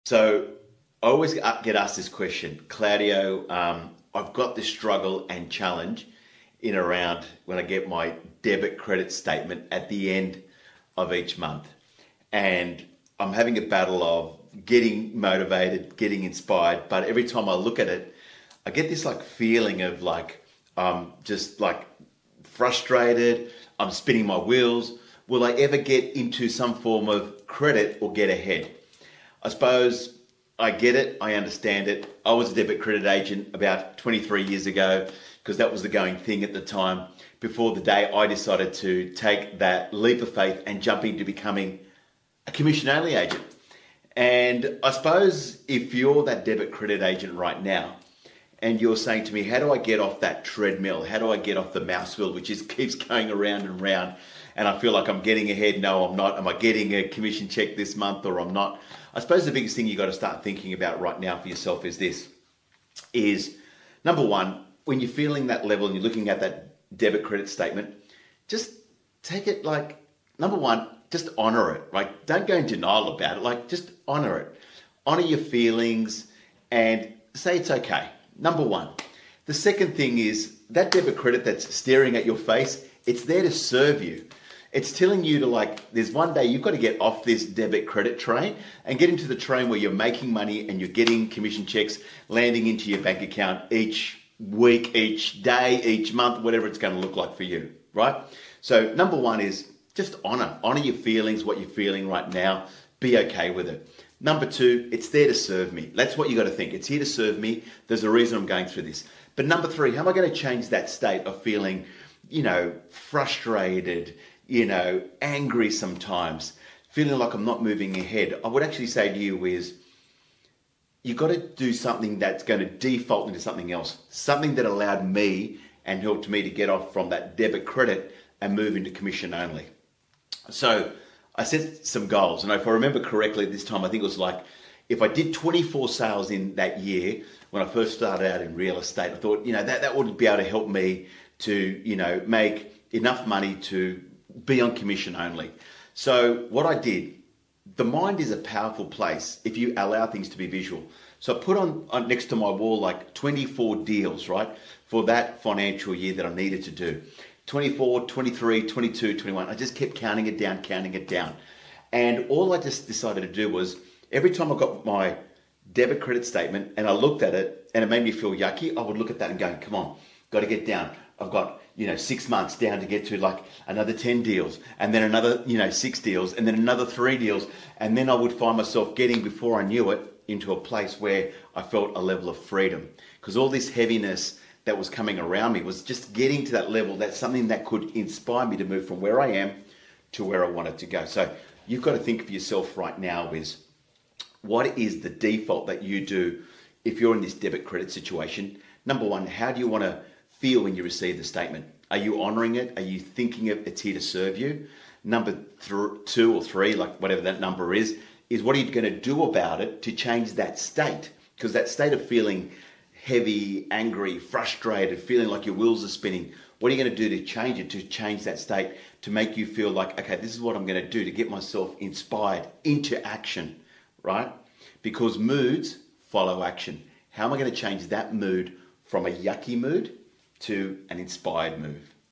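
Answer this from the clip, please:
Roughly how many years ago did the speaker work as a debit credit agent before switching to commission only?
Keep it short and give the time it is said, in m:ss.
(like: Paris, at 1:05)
23, at 0:33.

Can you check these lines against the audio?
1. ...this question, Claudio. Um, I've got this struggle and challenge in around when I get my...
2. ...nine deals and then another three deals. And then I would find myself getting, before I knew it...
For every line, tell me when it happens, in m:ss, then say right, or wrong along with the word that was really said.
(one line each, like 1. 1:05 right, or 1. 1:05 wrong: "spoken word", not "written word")
1. 0:01 right
2. 2:55 wrong: "six", not "nine".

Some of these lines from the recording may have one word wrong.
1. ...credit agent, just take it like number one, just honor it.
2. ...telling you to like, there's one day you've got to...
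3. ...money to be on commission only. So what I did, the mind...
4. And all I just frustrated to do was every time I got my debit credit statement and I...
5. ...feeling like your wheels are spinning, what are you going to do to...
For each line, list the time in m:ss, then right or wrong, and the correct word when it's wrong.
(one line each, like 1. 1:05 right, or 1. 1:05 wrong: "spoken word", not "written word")
1. 1:07 wrong: "statement", not "agent"
2. 1:24 right
3. 2:23 right
4. 2:41 wrong: "decided", not "frustrated"
5. 3:34 right.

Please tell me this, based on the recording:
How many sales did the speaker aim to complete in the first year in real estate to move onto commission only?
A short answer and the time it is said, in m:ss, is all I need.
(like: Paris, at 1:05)
24, at 2:15.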